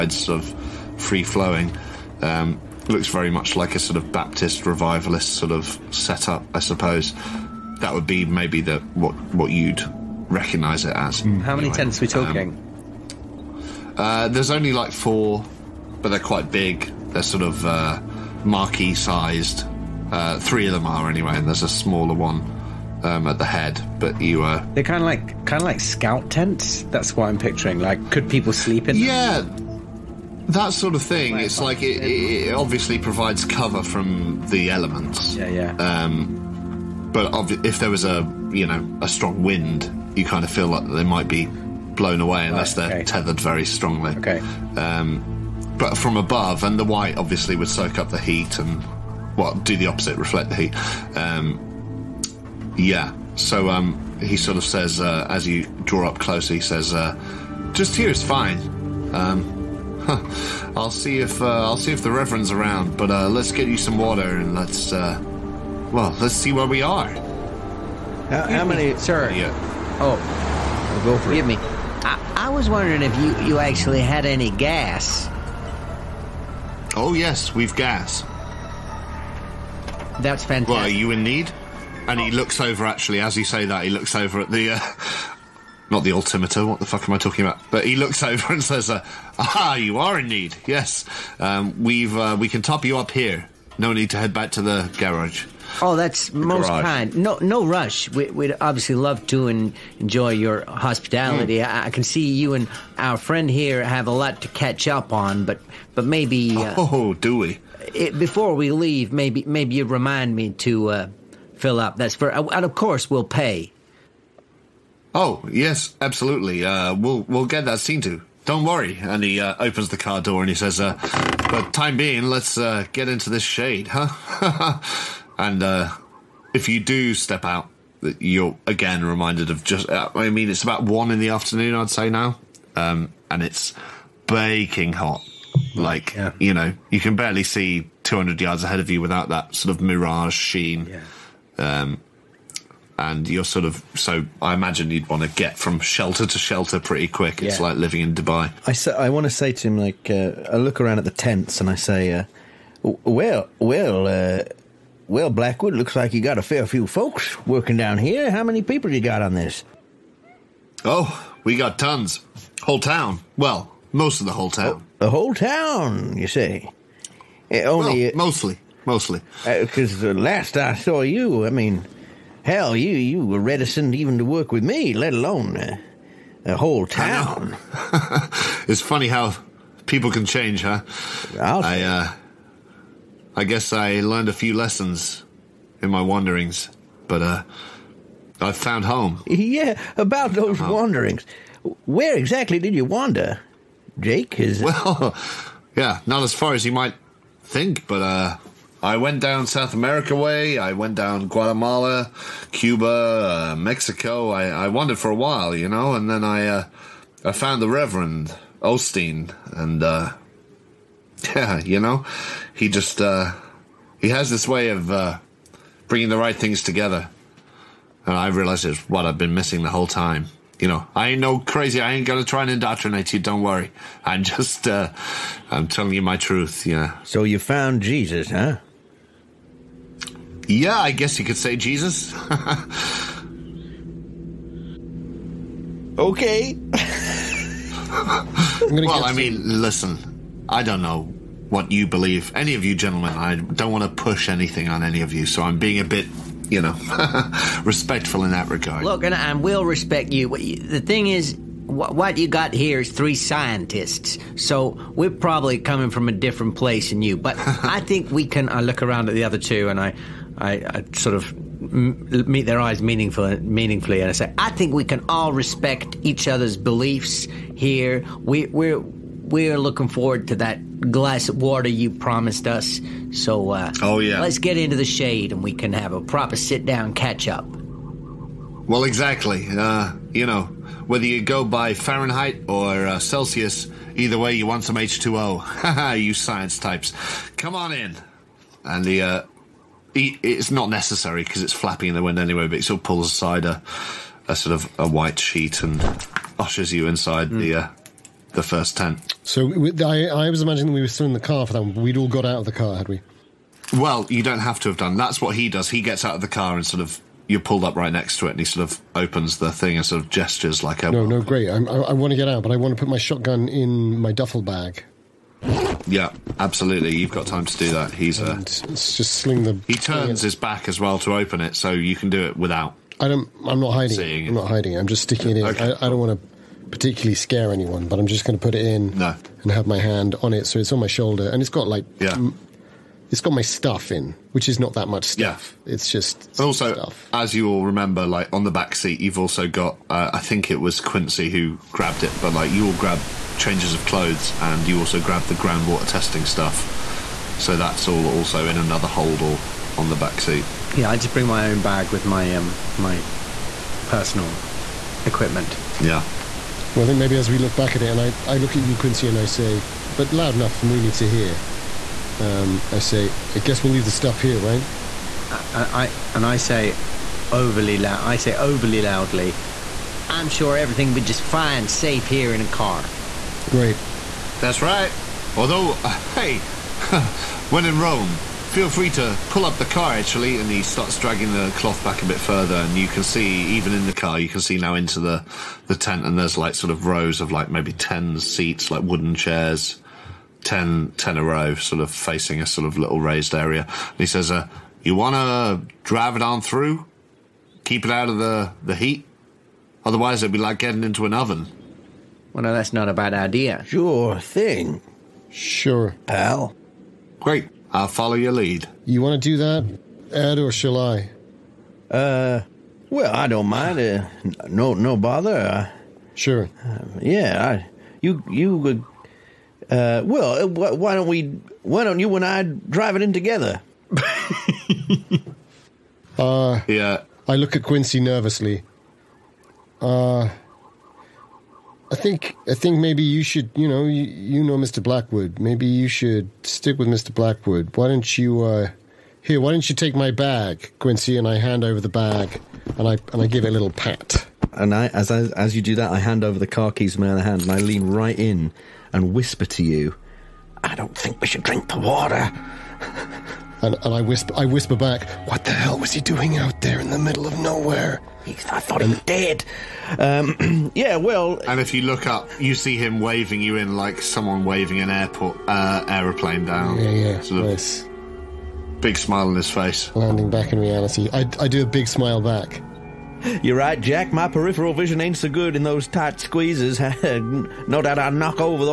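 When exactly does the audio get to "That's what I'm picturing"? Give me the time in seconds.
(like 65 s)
26 s.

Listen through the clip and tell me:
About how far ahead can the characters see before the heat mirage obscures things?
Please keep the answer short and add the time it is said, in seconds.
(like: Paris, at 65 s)
200 yards, at 138 s.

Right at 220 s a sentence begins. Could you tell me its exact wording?
You know, I ain't no crazy.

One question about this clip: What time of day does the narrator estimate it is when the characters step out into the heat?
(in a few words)
1 in the afternoon.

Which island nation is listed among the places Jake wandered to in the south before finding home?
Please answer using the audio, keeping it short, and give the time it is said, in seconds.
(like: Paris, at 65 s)
Cuba, at 202 s.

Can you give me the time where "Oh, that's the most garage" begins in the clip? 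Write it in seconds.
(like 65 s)
95 s.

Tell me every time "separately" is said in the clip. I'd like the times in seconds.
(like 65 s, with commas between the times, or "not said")
not said.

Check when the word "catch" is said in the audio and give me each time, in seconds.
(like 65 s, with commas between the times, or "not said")
104 s, 276 s.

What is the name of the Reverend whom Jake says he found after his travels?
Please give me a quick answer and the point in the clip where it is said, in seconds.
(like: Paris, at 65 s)
Osteen, at 208 s.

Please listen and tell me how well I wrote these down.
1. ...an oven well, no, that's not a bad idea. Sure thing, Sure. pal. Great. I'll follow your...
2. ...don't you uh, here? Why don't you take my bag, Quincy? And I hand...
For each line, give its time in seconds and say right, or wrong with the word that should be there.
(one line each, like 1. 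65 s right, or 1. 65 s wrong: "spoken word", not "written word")
1. 401 s right
2. 437 s right.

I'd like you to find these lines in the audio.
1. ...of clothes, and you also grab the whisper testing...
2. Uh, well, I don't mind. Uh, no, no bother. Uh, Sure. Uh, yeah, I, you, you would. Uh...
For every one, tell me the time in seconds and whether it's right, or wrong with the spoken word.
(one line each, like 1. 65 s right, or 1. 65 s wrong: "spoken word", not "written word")
1. 343 s wrong: "groundwater", not "whisper"
2. 411 s right.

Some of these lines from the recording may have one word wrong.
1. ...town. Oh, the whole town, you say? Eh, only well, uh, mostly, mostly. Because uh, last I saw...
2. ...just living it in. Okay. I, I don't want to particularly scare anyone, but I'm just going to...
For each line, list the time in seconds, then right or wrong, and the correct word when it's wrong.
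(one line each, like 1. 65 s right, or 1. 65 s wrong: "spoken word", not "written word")
1. 164 s right
2. 324 s wrong: "sticking", not "living".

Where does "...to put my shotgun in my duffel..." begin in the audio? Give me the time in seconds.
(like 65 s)
312 s.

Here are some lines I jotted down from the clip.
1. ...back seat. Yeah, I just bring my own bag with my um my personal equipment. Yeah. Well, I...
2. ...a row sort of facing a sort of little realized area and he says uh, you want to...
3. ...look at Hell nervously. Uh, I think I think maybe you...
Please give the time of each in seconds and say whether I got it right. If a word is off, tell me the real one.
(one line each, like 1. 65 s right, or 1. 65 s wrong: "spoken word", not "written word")
1. 349 s right
2. 391 s wrong: "raised", not "realized"
3. 427 s wrong: "Quincy", not "Hell".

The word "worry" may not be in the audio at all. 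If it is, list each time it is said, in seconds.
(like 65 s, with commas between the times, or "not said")
118 s, 223 s.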